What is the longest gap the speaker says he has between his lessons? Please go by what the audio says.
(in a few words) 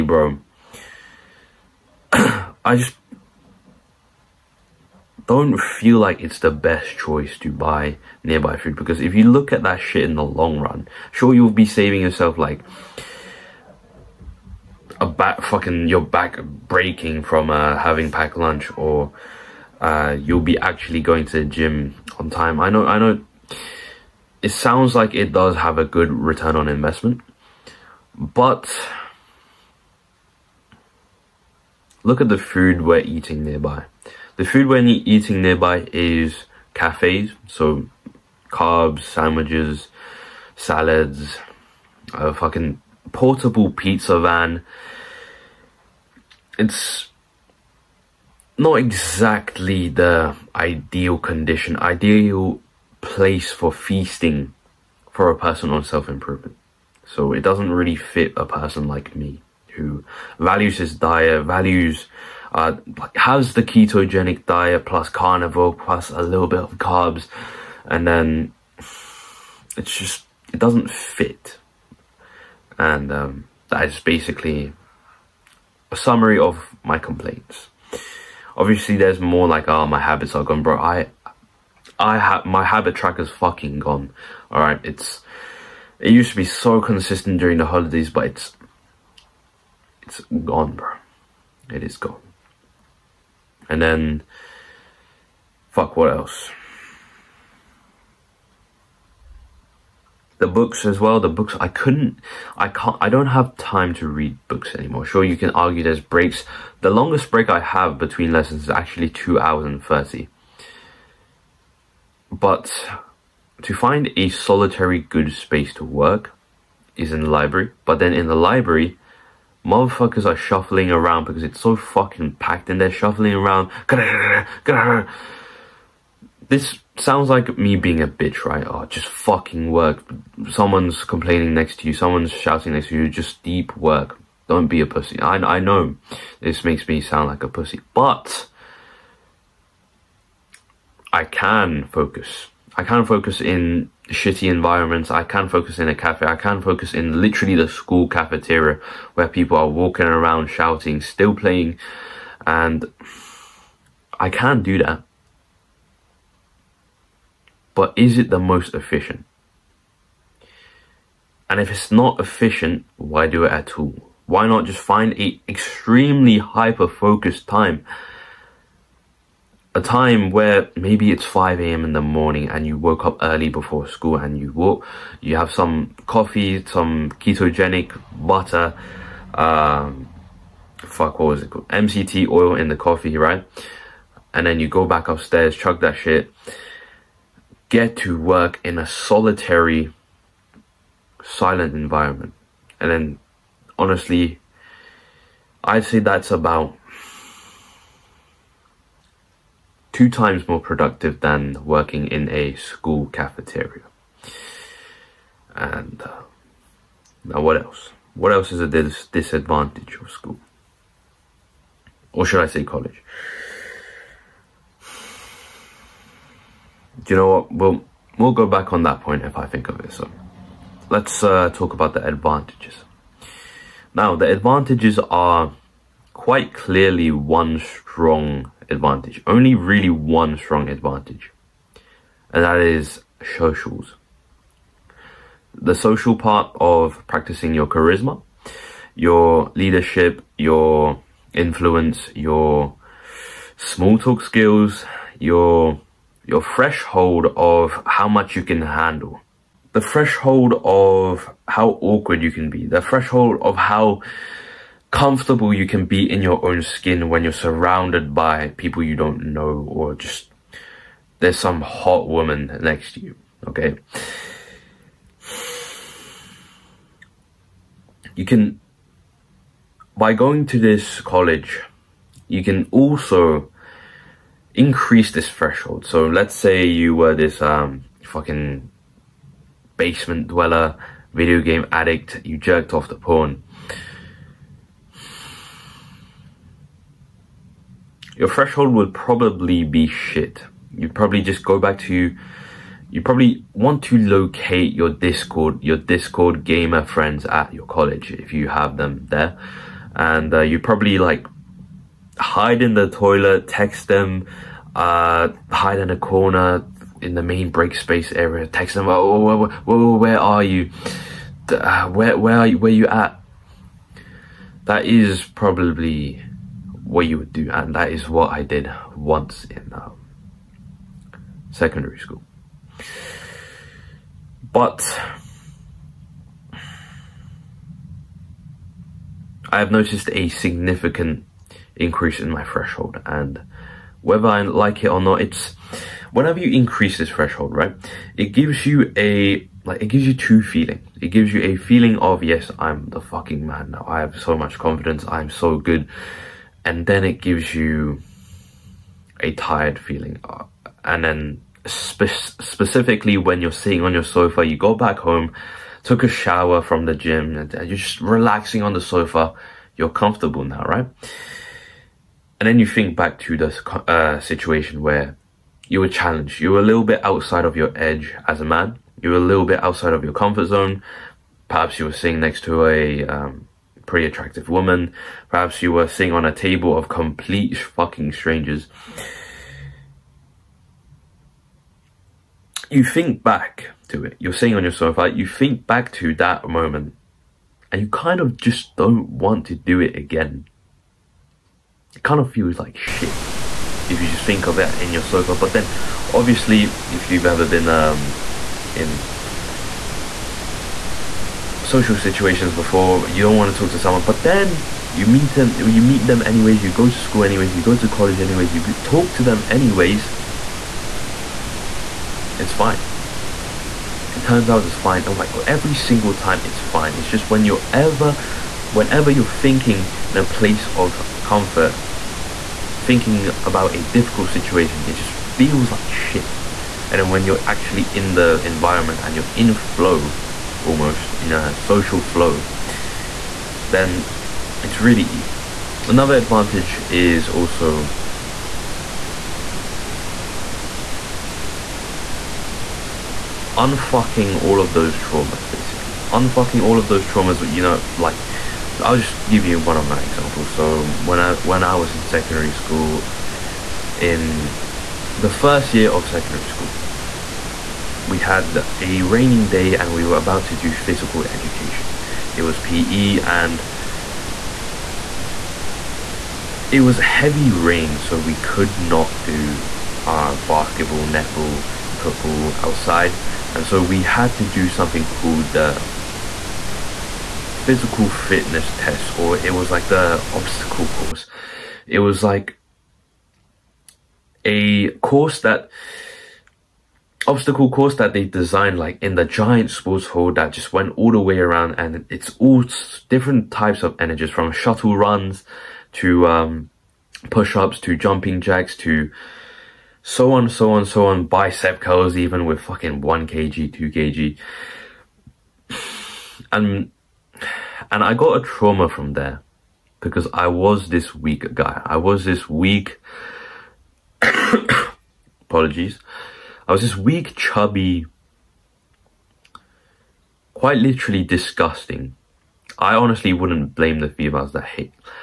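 2 hours and 30.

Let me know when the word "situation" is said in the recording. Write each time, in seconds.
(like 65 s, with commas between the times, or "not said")
364 s, 401 s, 424 s.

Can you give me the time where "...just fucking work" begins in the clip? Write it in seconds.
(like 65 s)
128 s.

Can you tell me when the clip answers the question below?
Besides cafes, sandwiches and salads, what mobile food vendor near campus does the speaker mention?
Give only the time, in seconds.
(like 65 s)
43 s.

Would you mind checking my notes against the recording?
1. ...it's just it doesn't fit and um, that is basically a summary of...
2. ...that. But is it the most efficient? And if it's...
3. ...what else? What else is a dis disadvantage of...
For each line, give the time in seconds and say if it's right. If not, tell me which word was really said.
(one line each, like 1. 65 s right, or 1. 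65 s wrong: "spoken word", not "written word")
1. 69 s right
2. 154 s right
3. 207 s right.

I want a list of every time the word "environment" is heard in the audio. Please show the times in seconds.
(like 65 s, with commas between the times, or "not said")
144 s, 191 s, 428 s.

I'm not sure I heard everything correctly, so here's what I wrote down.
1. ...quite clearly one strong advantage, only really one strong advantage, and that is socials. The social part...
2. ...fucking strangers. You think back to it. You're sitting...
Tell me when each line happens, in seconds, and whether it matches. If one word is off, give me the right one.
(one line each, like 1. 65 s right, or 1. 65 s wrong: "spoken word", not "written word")
1. 226 s right
2. 377 s right.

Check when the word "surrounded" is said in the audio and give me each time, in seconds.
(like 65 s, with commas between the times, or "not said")
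257 s.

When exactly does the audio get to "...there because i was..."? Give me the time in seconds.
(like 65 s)
509 s.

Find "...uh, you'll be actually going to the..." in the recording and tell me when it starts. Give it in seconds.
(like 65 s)
19 s.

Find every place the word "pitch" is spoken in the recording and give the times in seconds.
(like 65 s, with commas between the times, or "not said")
not said.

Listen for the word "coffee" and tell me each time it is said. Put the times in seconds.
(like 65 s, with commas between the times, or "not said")
176 s, 182 s.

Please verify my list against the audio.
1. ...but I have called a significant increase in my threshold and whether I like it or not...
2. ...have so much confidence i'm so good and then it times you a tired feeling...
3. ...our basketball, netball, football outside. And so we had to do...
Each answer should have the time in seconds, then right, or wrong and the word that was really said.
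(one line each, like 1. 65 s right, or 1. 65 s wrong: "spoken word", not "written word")
1. 324 s wrong: "noticed", not "called"
2. 343 s wrong: "gives", not "times"
3. 470 s right.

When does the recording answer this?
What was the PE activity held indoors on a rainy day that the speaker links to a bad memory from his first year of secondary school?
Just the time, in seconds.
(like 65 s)
477 s.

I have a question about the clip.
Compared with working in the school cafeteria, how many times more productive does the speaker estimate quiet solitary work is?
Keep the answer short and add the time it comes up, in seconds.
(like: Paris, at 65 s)
2, at 199 s.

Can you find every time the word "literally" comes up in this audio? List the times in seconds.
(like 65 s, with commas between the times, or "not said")
147 s, 520 s.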